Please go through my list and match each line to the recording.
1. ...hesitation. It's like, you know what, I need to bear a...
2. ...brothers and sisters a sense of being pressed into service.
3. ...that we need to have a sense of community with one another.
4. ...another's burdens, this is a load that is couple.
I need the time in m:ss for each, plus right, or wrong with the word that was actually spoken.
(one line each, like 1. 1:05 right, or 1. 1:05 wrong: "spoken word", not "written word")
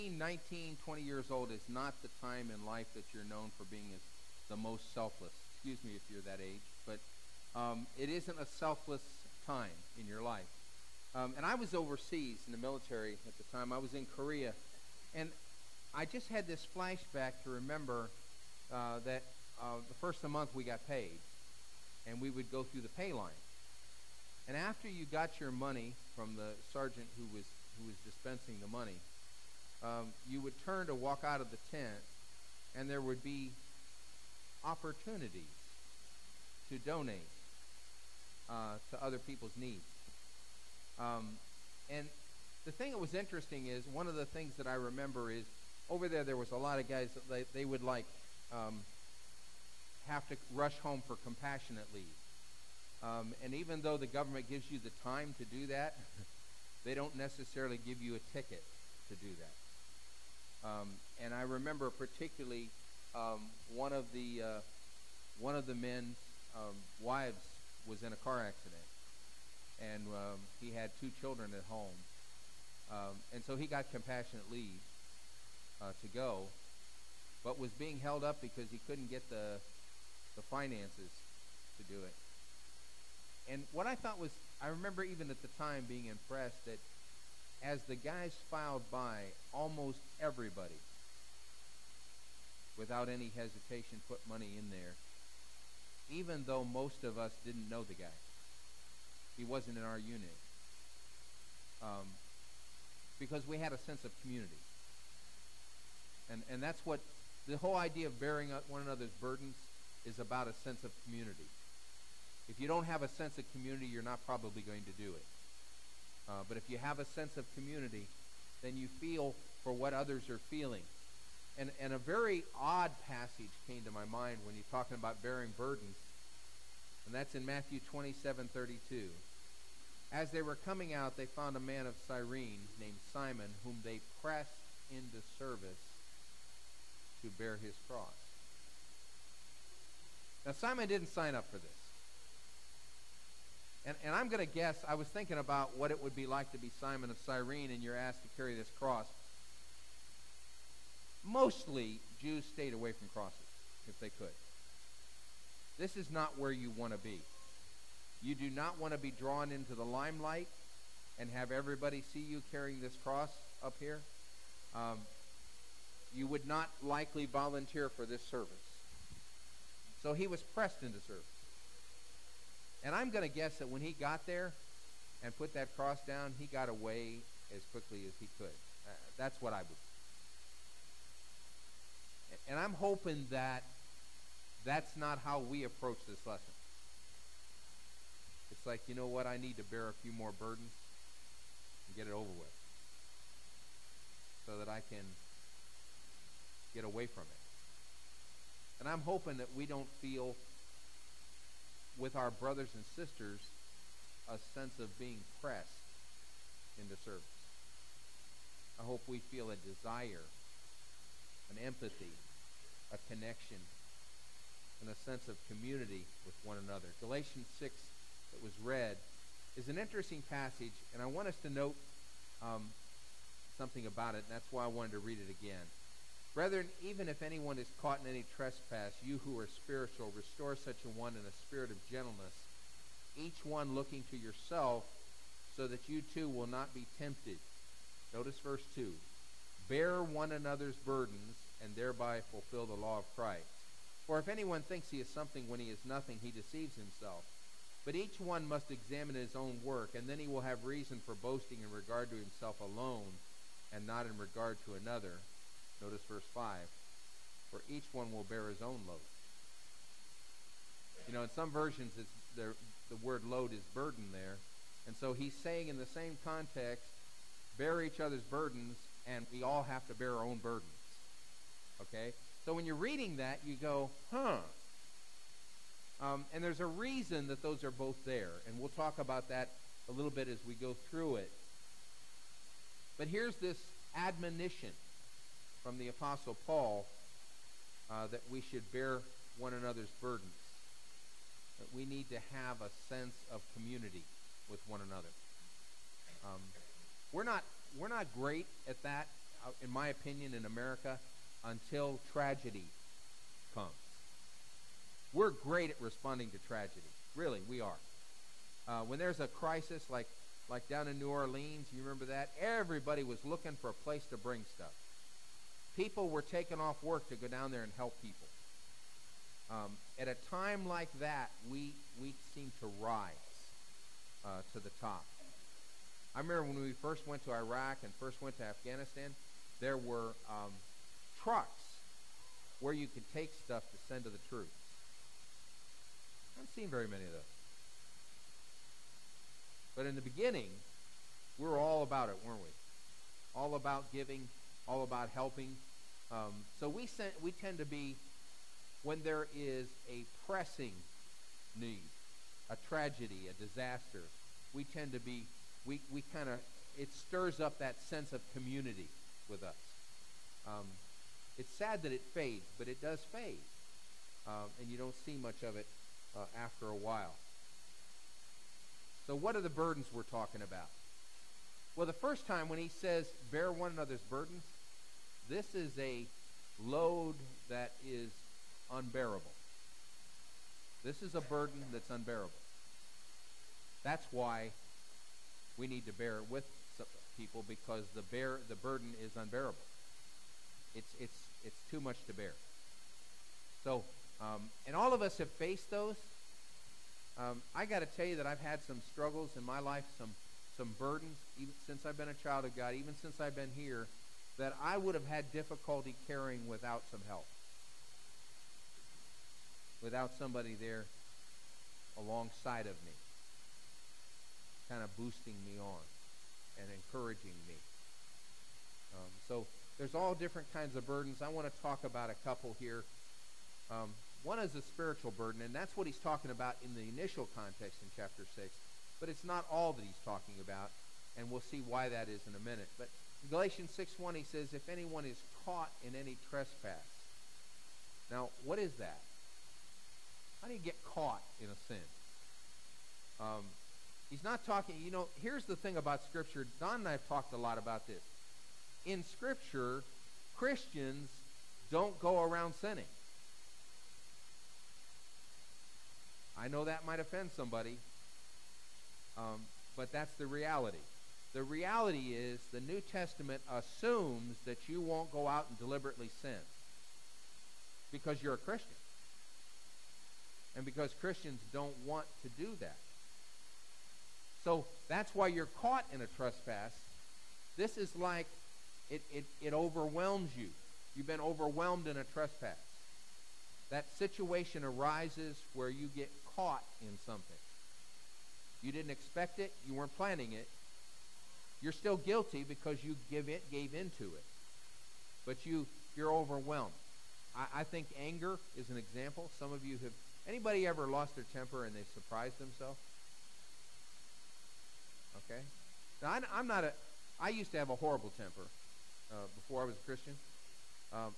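1. 3:06 wrong: "lesson", not "hesitation"
2. 3:22 right
3. 4:51 right
4. 6:13 wrong: "unbearable", not "couple".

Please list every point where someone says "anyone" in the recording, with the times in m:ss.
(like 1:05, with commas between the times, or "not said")
3:47, 4:04, 7:14.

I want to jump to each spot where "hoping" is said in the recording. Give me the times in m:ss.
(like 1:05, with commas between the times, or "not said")
3:02, 3:19.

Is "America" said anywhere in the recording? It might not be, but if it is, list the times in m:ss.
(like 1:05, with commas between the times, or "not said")
5:00.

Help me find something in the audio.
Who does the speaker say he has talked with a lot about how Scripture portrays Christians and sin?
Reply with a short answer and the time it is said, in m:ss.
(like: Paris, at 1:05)
Don, at 7:26.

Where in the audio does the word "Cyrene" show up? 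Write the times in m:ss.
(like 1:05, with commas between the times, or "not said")
2:12, 2:27.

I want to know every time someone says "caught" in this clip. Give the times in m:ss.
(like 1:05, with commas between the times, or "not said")
3:47, 7:15, 7:20, 7:55, 8:06.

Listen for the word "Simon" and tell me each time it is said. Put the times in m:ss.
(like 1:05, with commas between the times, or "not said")
2:13, 2:20, 2:26.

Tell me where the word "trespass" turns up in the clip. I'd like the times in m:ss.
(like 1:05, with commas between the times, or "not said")
3:48, 7:16, 7:56, 8:02.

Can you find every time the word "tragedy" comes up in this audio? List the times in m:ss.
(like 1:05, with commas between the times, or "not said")
5:02, 5:06, 5:52.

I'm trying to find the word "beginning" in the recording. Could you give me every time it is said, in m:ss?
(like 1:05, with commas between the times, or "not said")
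5:40.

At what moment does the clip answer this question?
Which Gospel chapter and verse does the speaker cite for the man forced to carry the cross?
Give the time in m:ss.
2:07.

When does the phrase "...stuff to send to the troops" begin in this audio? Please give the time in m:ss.
5:33.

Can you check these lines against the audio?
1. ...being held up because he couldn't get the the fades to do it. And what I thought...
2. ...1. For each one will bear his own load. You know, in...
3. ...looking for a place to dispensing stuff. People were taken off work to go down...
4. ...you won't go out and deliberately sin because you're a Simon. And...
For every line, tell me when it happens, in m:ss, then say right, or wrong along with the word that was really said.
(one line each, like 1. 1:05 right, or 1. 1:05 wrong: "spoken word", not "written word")
1. 1:17 wrong: "finances", not "fades"
2. 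4:16 wrong: "5", not "1"
3. 5:13 wrong: "bring", not "dispensing"
4. 7:44 wrong: "Christian", not "Simon".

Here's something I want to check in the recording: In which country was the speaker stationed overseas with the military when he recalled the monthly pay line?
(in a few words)
Korea.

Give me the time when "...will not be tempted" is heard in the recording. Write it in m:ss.
3:56.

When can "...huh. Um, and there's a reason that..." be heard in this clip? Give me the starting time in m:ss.
4:34.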